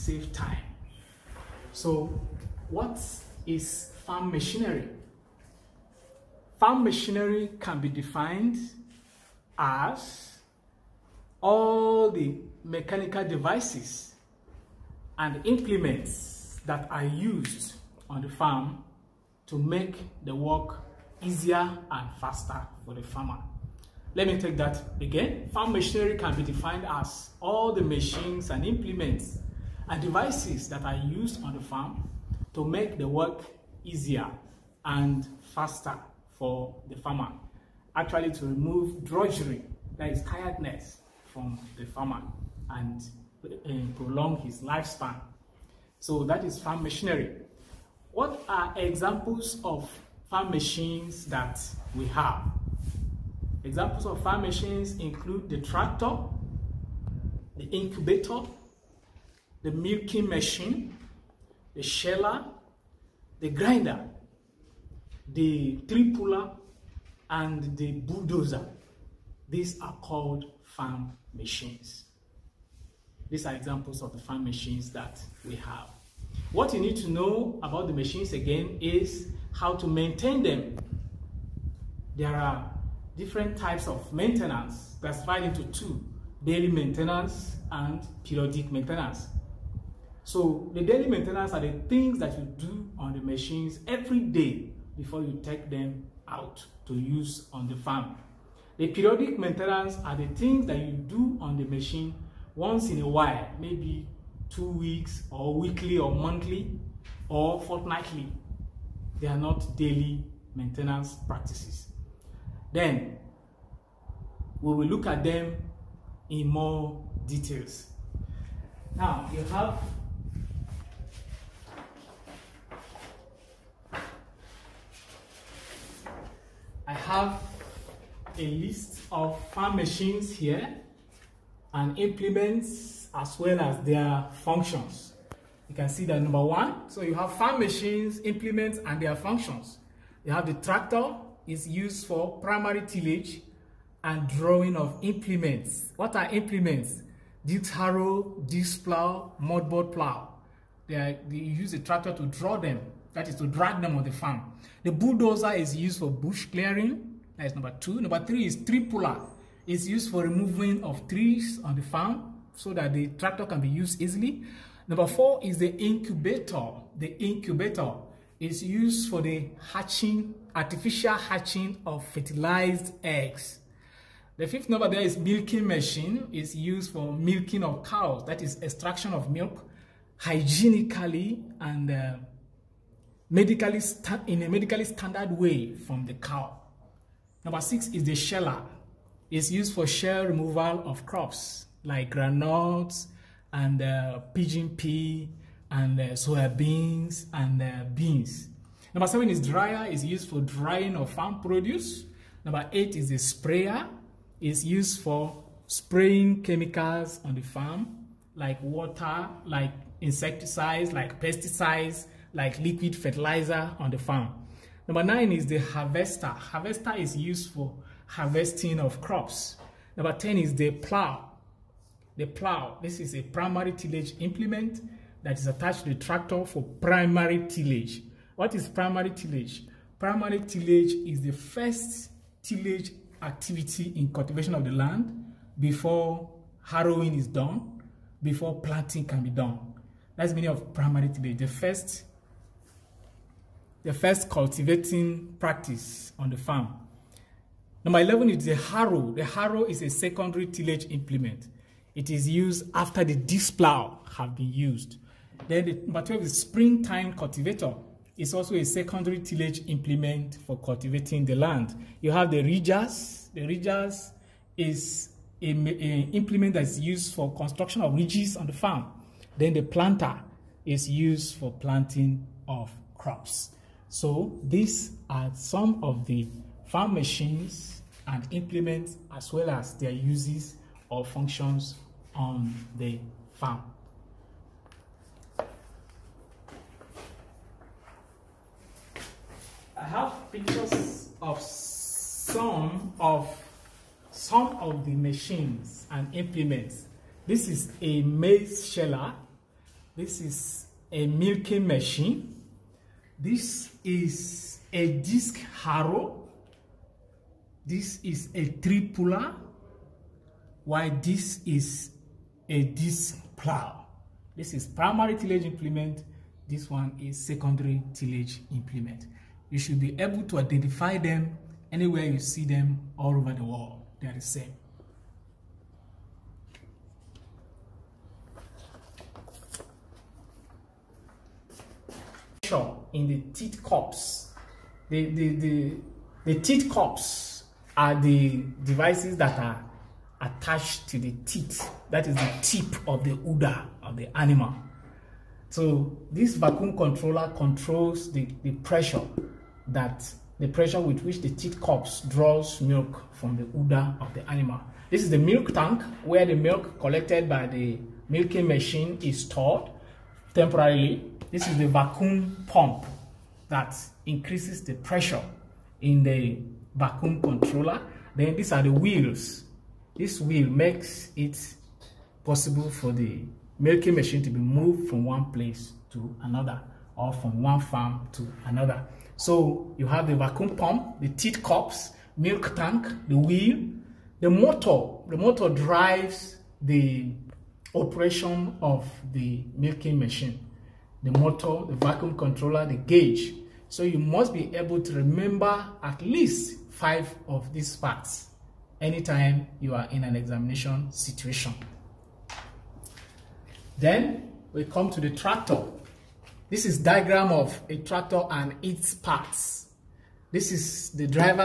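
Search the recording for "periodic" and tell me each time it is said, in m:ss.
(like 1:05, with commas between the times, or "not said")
1:28, 1:38.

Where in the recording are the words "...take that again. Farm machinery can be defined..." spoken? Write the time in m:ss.
0:24.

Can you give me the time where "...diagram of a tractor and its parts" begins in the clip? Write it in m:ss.
6:46.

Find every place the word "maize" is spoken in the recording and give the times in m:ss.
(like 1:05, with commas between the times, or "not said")
4:58.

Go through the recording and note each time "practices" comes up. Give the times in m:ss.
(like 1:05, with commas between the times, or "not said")
1:51, 4:05.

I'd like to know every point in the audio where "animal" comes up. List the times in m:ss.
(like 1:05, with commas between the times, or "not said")
5:44, 5:54.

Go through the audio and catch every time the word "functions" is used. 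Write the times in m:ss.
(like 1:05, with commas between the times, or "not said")
2:14, 2:19, 4:41.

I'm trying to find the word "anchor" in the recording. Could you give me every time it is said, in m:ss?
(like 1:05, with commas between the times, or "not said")
not said.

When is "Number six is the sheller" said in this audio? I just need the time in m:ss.
3:07.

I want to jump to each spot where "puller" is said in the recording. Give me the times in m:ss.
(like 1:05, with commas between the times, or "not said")
1:06, 2:38, 5:08.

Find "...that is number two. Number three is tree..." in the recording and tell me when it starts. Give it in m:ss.
2:37.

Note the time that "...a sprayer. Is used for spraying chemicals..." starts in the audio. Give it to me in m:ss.
3:23.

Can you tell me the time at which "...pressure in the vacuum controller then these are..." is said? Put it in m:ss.
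6:04.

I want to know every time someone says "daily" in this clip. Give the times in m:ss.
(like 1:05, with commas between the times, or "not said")
1:26, 1:30, 1:49.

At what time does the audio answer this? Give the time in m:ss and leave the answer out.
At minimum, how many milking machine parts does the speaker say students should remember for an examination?
6:36.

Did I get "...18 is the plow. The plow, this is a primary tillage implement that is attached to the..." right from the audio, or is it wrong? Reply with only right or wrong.
wrong.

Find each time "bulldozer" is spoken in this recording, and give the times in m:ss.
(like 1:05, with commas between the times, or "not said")
1:07, 2:34.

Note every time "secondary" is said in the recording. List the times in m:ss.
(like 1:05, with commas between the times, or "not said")
4:09, 4:18, 5:17.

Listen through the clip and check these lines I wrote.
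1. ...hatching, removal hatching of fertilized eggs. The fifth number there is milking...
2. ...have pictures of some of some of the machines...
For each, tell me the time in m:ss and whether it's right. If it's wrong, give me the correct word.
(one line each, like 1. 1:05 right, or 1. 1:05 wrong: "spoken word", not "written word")
1. 2:49 wrong: "artificial", not "removal"
2. 4:49 right.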